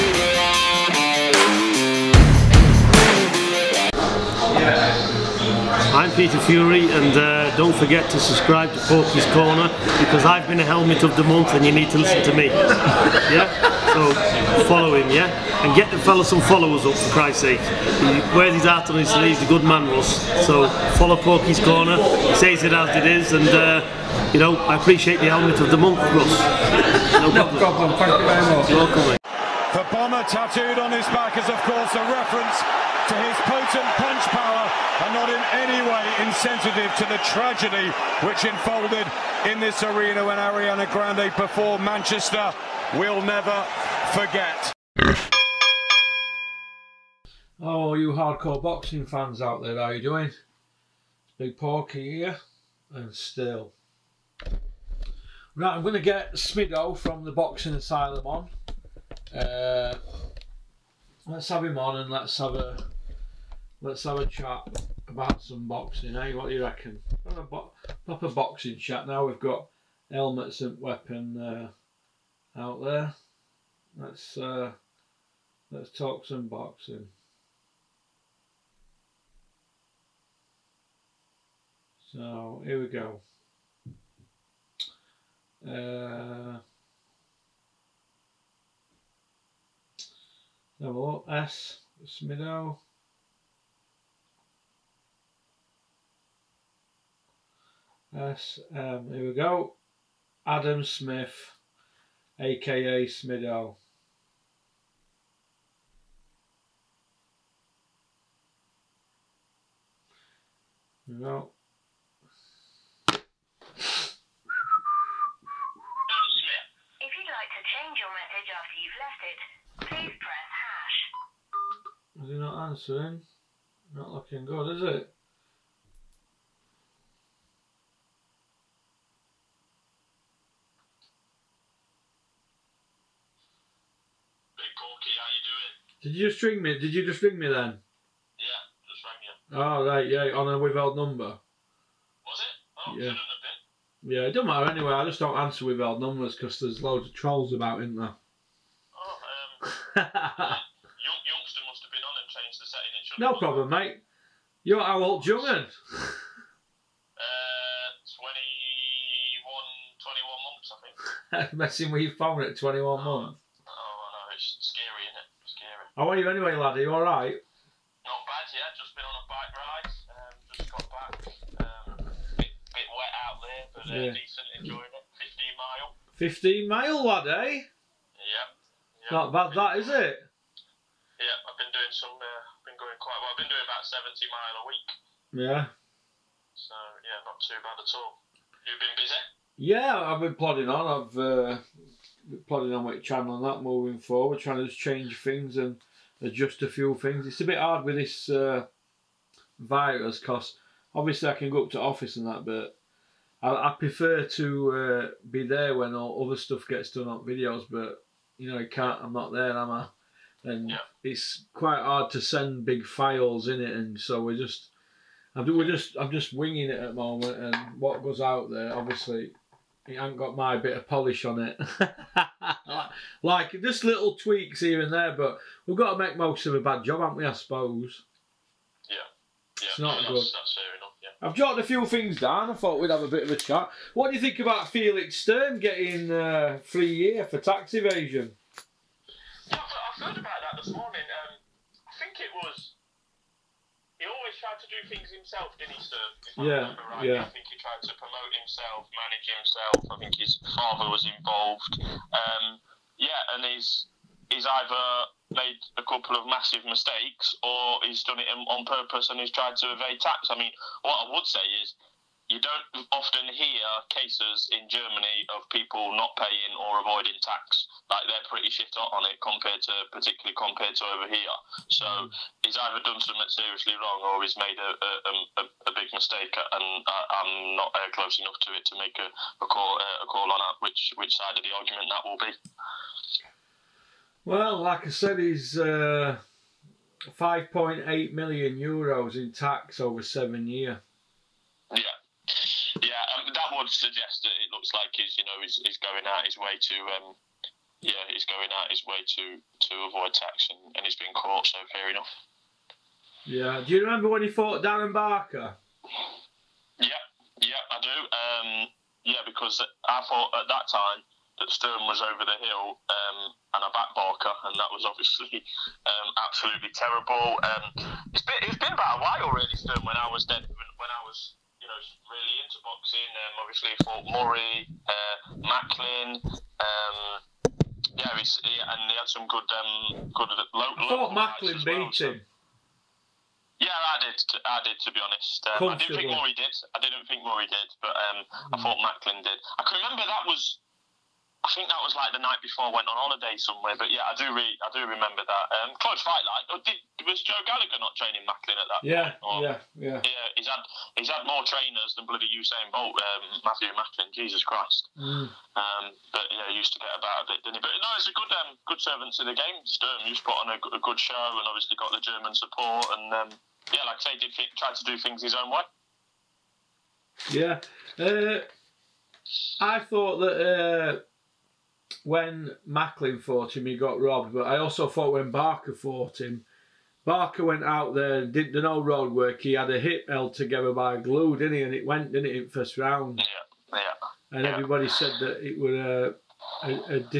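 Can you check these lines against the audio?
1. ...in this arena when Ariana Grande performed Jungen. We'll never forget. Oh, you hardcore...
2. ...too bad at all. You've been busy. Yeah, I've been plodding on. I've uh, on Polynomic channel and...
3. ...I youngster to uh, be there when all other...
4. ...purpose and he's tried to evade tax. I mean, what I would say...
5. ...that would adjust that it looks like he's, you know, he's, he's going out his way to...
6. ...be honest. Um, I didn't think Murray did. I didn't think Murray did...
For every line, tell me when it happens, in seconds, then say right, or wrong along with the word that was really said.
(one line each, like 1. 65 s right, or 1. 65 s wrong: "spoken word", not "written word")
1. 39 s wrong: "Manchester", not "Jungen"
2. 187 s right
3. 203 s wrong: "prefer", not "youngster"
4. 258 s right
5. 293 s wrong: "suggest", not "adjust"
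6. 334 s right.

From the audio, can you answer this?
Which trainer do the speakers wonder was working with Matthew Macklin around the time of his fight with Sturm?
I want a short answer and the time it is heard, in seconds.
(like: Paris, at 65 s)
Joe Gallagher, at 347 s.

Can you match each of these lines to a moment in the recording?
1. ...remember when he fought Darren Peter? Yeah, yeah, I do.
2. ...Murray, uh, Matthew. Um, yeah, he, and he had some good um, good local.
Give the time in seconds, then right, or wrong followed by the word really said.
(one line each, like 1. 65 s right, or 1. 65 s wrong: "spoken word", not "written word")
1. 303 s wrong: "Barker", not "Peter"
2. 324 s wrong: "Macklin", not "Matthew".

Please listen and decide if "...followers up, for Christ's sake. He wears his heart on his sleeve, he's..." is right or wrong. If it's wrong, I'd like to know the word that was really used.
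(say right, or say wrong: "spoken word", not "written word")
right.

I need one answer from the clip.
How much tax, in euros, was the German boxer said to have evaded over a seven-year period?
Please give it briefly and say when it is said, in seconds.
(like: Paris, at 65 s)
5.8 million euros, at 287 s.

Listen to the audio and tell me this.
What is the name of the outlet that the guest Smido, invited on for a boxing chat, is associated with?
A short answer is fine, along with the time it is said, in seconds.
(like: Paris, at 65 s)
the Boxing Asylum, at 57 s.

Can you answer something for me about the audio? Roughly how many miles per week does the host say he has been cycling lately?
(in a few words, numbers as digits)
70.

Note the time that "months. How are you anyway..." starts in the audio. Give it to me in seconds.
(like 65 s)
163 s.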